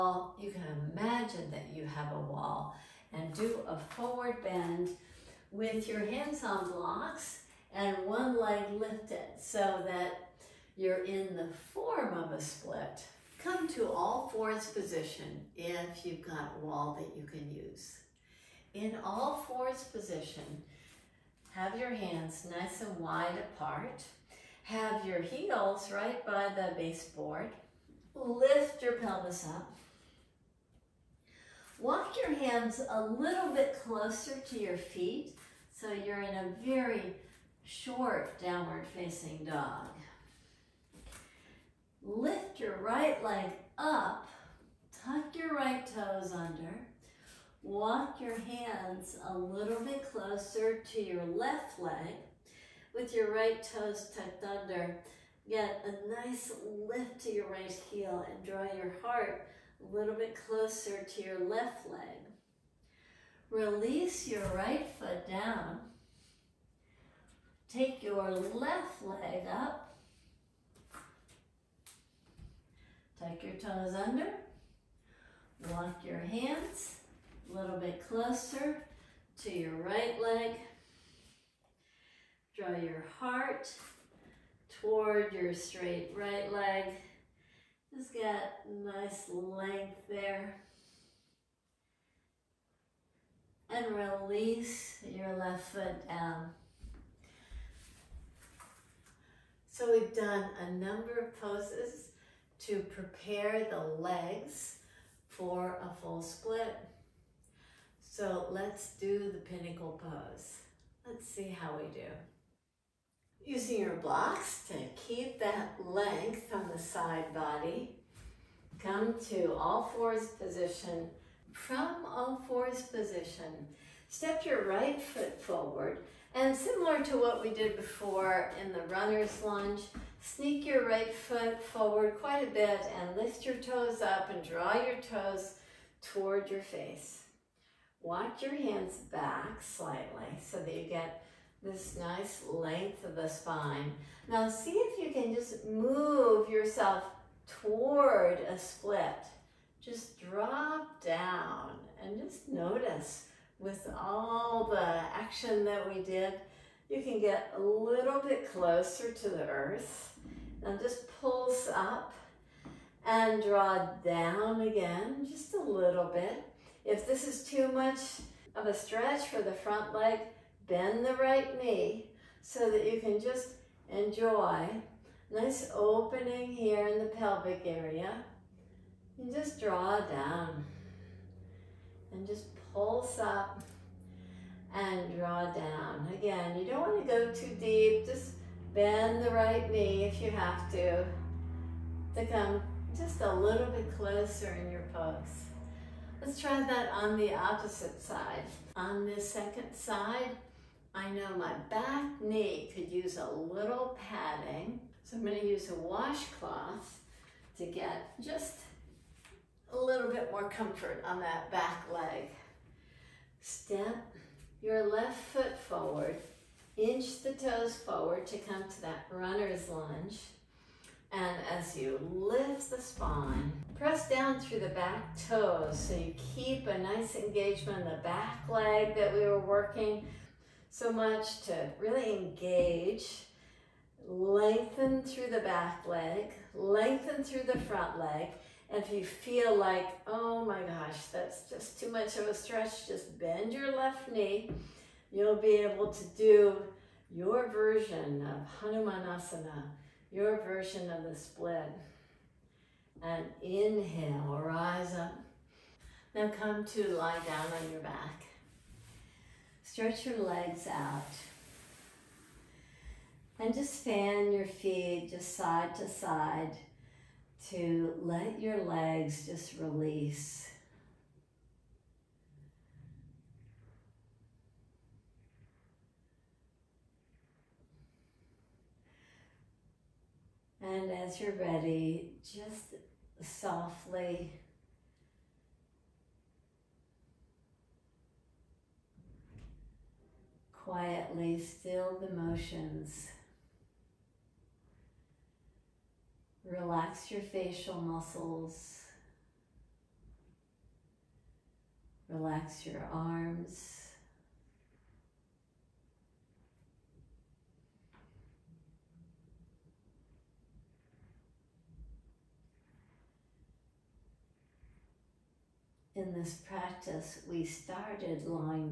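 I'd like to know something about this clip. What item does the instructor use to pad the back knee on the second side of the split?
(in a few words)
washcloth.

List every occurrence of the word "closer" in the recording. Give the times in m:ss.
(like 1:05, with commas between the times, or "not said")
0:33, 0:50, 1:00, 1:18, 2:38, 3:13.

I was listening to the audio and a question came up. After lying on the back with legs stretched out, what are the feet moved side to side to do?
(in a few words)
fan.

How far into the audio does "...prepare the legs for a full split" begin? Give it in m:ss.
1:42.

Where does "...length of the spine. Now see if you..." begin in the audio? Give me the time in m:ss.
2:22.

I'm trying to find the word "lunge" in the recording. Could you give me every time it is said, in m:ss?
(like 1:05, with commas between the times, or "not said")
2:09, 3:39.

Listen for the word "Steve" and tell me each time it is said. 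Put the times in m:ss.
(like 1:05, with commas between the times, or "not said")
not said.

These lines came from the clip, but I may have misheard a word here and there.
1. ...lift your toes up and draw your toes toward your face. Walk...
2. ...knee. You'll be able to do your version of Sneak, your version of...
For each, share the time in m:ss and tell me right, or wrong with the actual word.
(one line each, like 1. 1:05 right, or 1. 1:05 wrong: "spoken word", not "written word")
1. 2:13 right
2. 4:04 wrong: "Hanumanasana", not "Sneak".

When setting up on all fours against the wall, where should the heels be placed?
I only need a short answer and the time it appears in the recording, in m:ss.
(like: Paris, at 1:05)
by the baseboard, at 0:25.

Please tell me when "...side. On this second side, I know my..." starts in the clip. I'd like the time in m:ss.
3:18.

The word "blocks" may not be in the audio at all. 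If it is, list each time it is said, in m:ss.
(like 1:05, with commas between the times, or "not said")
0:06, 1:53.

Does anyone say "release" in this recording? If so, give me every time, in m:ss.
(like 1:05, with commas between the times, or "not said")
1:03, 1:33, 4:29.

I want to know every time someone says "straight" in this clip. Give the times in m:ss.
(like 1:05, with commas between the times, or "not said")
1:25.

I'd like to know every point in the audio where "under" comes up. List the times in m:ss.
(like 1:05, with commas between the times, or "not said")
0:46, 0:54, 1:13.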